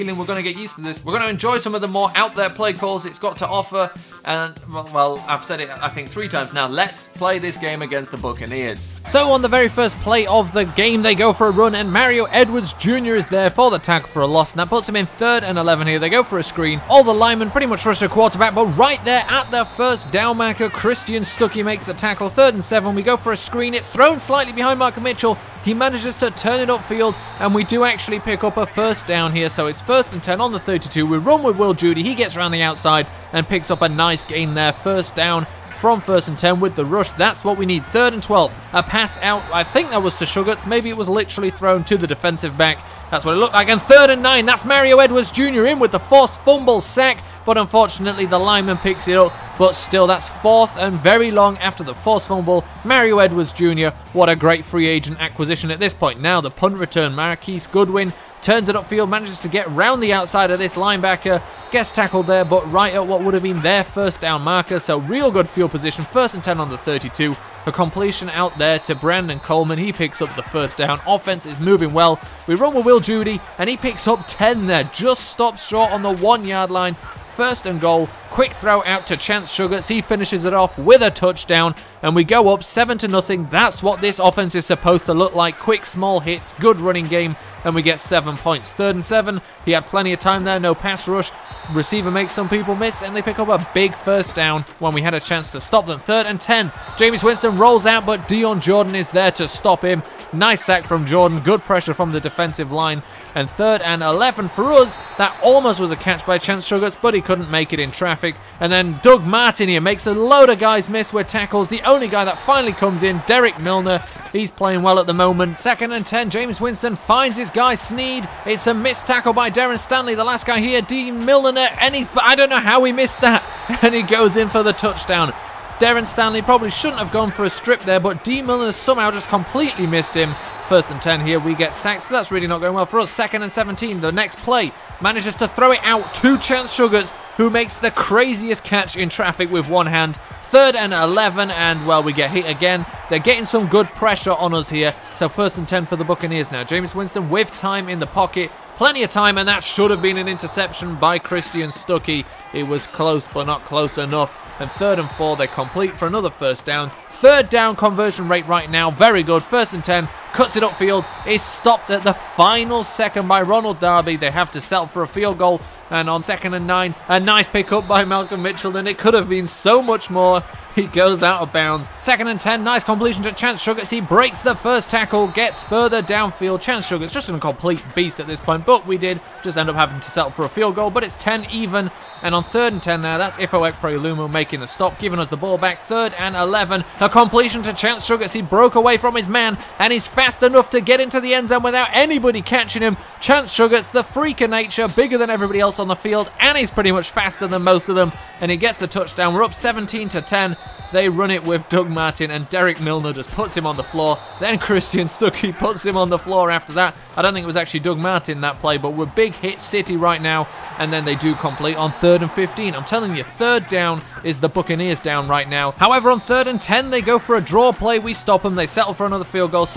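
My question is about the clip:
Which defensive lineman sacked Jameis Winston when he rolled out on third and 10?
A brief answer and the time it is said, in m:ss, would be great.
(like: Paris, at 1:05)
Dion Jordan, at 1:38.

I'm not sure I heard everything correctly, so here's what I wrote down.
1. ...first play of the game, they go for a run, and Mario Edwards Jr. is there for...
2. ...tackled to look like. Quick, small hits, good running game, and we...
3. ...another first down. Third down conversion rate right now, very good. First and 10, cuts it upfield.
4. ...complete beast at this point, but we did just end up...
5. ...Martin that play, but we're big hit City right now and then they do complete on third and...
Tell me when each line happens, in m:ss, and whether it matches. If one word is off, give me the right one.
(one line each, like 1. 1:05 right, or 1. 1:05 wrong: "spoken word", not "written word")
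1. 0:09 right
2. 1:24 wrong: "supposed", not "tackled"
3. 2:36 right
4. 2:57 right
5. 3:27 right.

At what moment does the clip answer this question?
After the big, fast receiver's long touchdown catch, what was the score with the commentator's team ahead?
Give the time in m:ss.
3:19.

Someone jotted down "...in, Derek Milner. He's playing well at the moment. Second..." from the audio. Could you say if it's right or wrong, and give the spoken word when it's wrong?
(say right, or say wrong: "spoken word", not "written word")
right.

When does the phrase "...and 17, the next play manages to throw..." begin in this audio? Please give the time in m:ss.
2:13.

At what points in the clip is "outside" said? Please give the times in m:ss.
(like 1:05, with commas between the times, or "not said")
0:32, 1:00.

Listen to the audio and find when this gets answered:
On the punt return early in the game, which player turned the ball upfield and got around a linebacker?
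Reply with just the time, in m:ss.
0:57.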